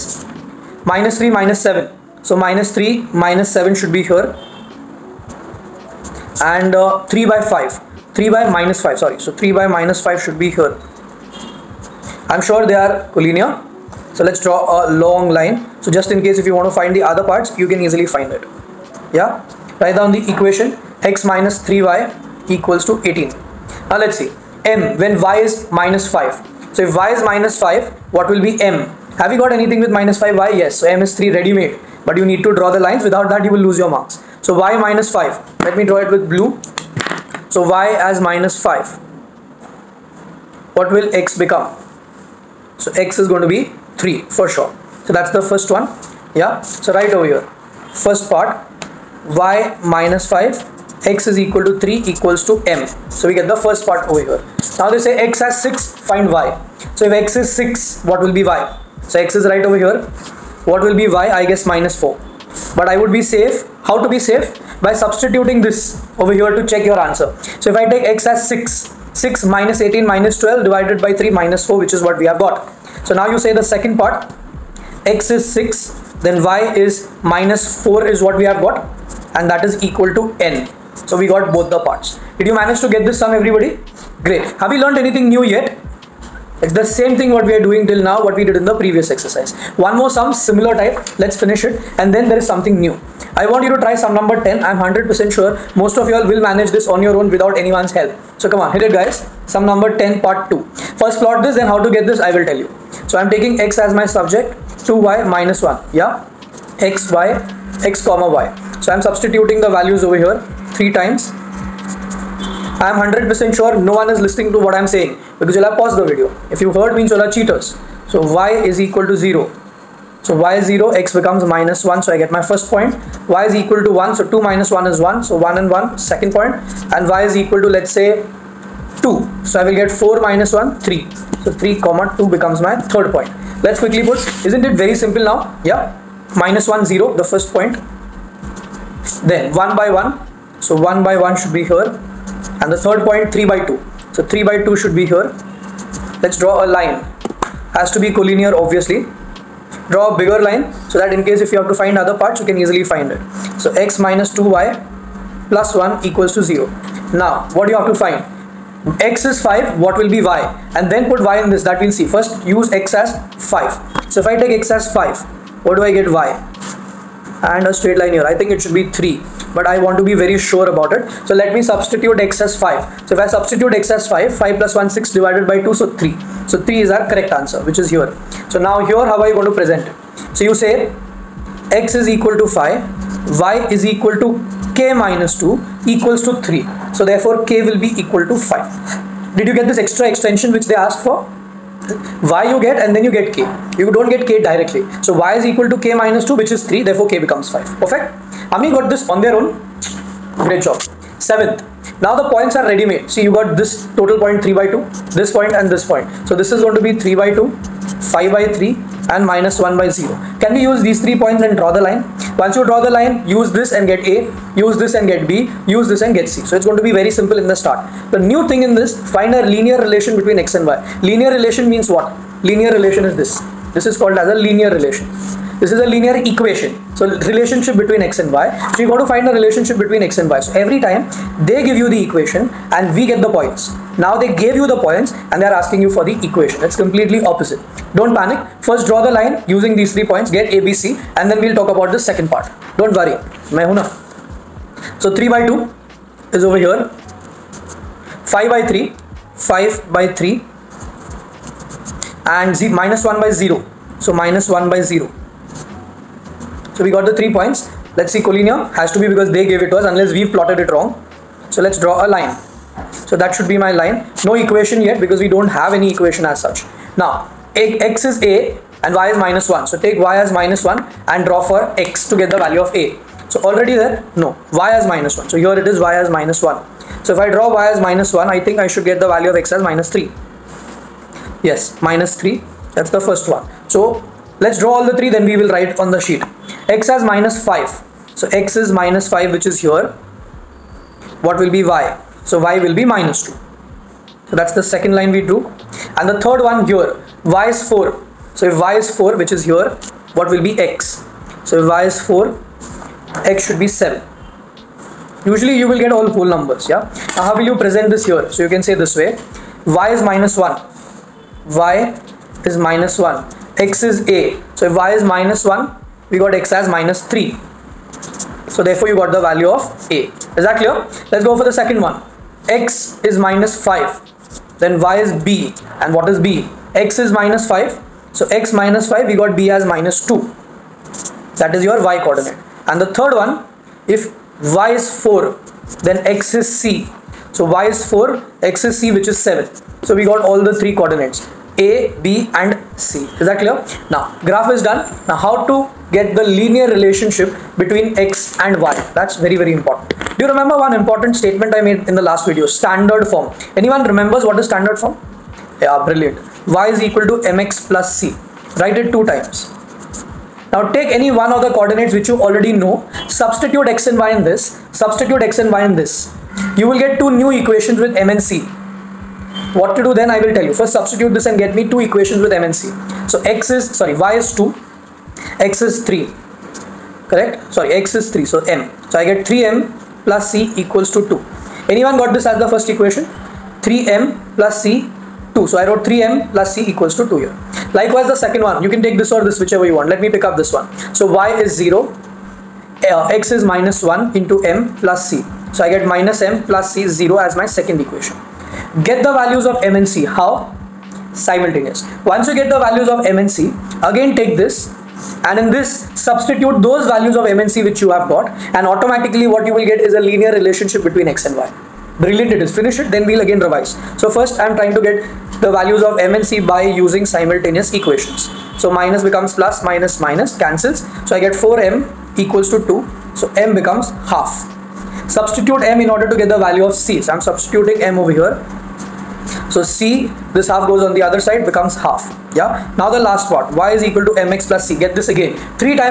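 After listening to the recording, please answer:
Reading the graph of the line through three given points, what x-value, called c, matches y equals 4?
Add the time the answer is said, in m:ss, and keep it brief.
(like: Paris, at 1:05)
7, at 5:03.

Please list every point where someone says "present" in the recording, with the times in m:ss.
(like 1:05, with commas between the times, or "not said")
2:59, 5:07.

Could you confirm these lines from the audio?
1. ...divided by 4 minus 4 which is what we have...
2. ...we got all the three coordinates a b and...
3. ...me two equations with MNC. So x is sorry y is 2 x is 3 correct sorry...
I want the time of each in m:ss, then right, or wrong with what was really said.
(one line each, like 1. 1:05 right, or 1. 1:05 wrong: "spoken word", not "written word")
1. 1:10 wrong: "3", not "4"
2. 5:39 right
3. 6:11 right.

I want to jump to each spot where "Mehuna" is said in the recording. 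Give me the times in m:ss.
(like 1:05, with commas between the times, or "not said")
4:03.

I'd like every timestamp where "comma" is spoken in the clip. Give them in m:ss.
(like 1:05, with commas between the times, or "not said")
1:48, 2:11.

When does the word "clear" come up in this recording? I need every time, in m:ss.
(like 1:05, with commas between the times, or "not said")
5:20, 5:43.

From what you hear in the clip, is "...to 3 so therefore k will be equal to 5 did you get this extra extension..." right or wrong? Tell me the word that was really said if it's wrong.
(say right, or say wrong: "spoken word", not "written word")
right.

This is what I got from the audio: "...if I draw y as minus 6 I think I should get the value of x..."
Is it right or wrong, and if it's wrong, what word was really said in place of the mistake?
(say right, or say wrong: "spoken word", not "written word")
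wrong: "1", not "6".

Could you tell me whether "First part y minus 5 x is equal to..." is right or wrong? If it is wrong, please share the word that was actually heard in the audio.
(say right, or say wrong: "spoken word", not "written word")
right.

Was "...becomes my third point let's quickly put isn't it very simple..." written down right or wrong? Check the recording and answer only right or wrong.
right.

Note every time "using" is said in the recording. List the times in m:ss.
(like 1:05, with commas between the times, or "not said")
3:59, 6:56.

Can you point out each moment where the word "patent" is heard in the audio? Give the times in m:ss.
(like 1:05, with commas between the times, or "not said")
not said.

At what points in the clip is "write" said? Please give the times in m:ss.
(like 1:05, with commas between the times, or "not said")
0:19, 4:45, 5:58.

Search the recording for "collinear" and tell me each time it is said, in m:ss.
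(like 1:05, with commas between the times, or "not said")
0:13, 2:28, 4:18.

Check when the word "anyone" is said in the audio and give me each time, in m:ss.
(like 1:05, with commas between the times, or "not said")
1:37, 5:53, 6:21.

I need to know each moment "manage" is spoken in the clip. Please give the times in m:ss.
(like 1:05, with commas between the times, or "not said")
1:22, 1:36.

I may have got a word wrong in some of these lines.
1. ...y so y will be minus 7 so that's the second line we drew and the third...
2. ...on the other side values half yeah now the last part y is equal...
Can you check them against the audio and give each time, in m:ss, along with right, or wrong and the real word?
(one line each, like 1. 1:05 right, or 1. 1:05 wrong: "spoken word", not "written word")
1. 4:51 wrong: "2", not "7"
2. 7:10 wrong: "becomes", not "values".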